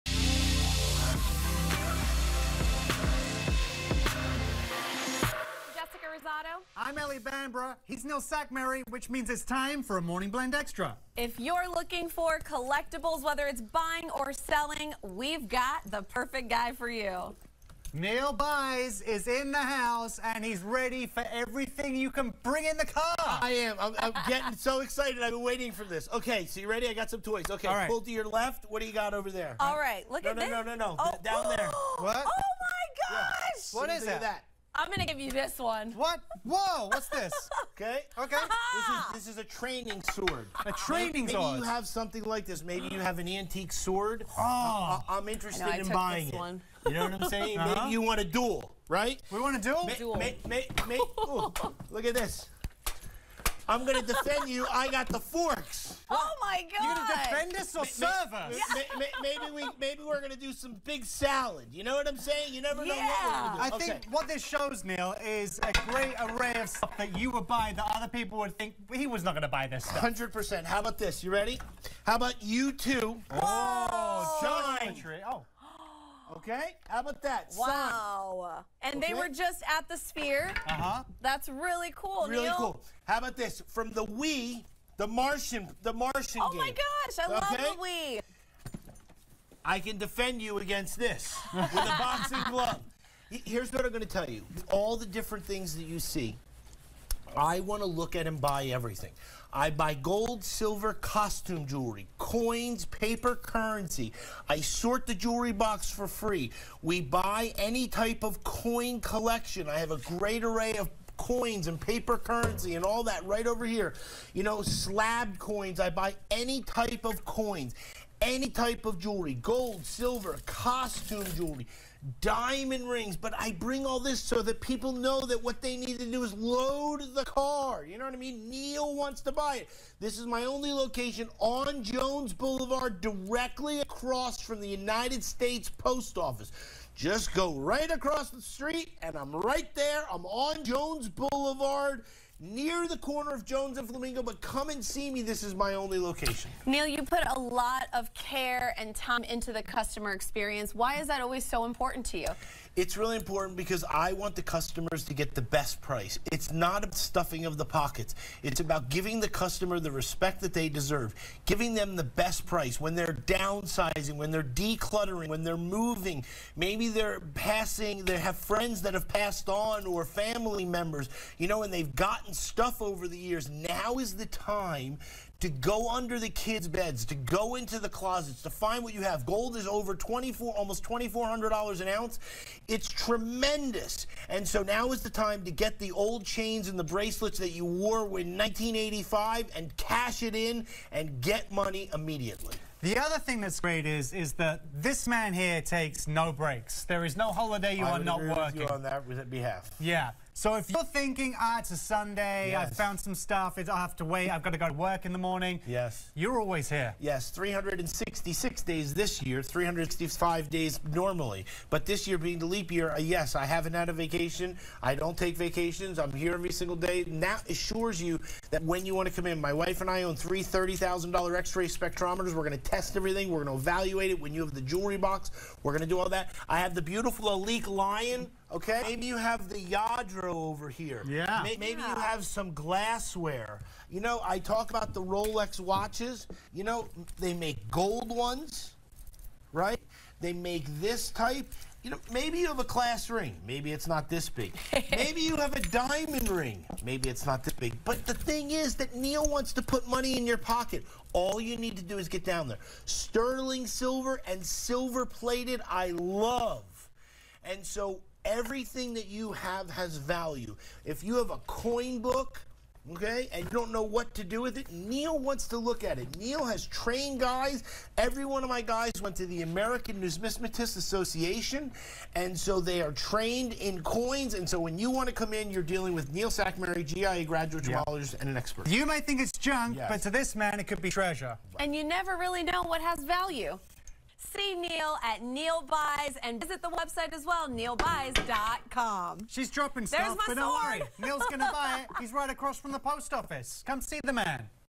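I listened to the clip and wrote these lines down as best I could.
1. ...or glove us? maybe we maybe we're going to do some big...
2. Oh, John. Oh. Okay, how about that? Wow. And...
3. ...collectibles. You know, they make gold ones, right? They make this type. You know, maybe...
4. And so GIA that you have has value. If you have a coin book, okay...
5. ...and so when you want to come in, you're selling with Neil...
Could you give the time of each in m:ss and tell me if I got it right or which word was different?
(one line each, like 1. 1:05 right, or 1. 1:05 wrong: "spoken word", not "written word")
1. 0:57 wrong: "serve", not "glove"
2. 1:13 right
3. 3:55 wrong: "watches", not "collectibles"
4. 4:17 wrong: "Everything", not "GIA"
5. 4:34 wrong: "dealing", not "selling".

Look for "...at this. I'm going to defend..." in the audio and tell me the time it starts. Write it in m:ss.
0:52.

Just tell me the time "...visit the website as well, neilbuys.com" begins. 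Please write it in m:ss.
4:46.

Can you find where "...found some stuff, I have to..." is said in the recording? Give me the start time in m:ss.
3:22.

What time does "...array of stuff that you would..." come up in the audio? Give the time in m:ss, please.
1:06.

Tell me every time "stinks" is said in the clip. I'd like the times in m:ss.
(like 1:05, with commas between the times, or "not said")
not said.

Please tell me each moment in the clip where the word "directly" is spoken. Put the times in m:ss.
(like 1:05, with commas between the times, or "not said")
2:13.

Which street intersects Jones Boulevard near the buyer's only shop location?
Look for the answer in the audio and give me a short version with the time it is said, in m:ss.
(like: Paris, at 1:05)
Flamingo, at 2:23.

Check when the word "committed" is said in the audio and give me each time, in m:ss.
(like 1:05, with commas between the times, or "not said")
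not said.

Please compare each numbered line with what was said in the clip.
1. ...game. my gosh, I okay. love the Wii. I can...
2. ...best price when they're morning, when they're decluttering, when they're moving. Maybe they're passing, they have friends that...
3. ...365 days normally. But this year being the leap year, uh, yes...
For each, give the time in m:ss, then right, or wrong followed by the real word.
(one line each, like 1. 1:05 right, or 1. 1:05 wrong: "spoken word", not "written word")
1. 1:26 right
2. 2:42 wrong: "downsizing", not "morning"
3. 3:29 right.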